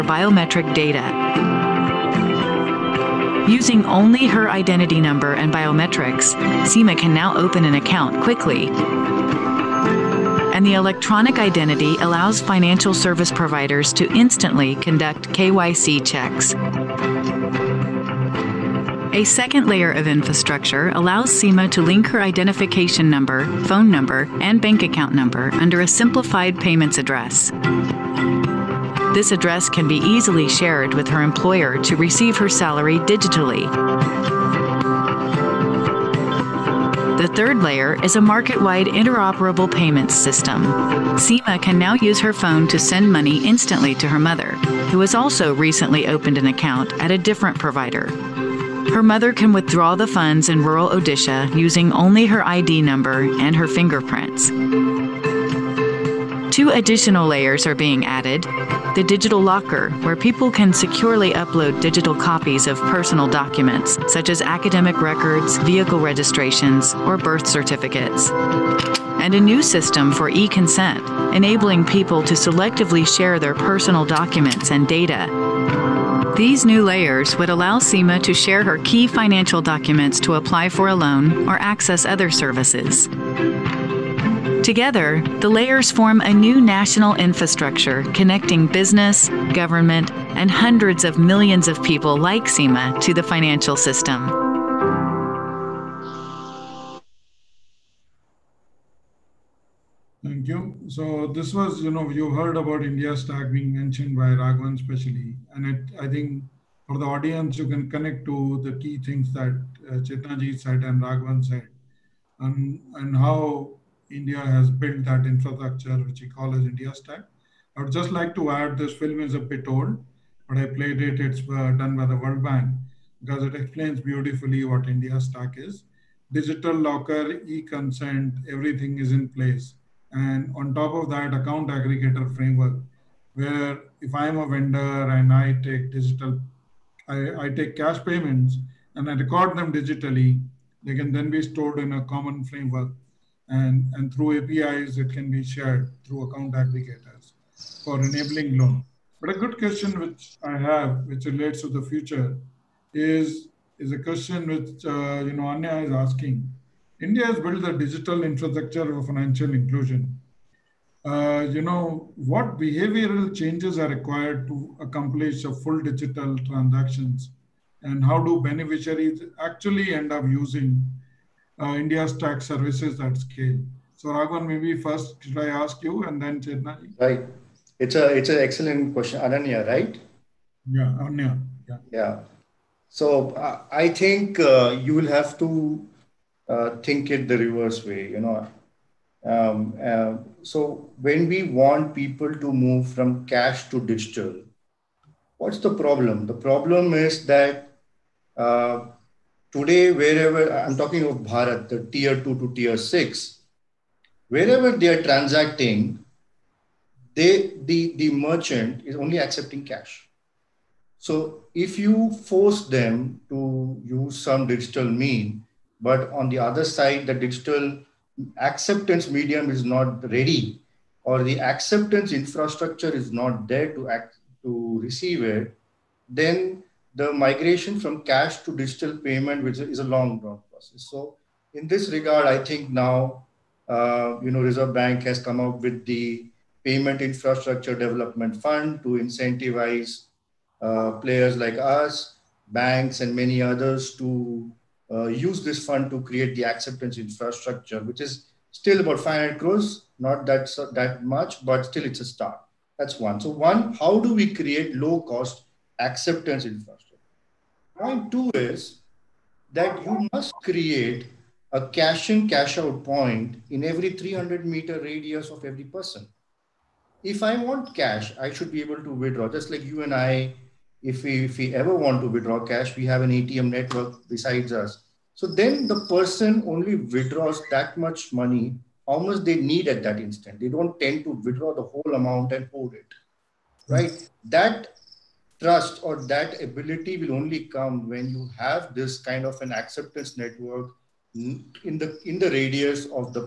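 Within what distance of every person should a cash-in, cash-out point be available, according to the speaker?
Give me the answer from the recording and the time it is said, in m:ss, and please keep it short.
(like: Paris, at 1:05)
300 meters, at 4:23.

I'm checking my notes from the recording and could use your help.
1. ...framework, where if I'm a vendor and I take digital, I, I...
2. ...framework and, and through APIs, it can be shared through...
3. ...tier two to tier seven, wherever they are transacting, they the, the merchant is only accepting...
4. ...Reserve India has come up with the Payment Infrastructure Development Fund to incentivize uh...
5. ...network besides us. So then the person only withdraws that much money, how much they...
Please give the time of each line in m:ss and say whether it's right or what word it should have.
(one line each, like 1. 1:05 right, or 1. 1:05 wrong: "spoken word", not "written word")
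1. 2:12 right
2. 2:22 right
3. 3:21 wrong: "six", not "seven"
4. 3:54 wrong: "Bank", not "India"
5. 4:33 right.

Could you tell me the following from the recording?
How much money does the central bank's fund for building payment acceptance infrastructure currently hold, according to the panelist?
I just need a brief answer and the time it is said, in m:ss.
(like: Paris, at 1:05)
500 crores, at 4:09.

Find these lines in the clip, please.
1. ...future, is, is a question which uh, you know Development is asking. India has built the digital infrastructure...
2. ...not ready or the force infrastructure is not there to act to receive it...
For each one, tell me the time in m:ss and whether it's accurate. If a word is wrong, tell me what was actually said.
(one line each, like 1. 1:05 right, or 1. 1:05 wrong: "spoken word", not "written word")
1. 2:31 wrong: "Anya", not "Development"
2. 3:39 wrong: "acceptance", not "force".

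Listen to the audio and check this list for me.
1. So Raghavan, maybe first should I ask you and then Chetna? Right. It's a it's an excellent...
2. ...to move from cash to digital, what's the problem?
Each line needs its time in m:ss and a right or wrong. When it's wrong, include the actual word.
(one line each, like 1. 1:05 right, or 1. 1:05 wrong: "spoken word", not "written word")
1. 2:53 right
2. 3:12 right.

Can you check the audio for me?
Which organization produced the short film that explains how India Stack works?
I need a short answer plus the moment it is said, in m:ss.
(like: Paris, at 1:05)
World Bank, at 2:02.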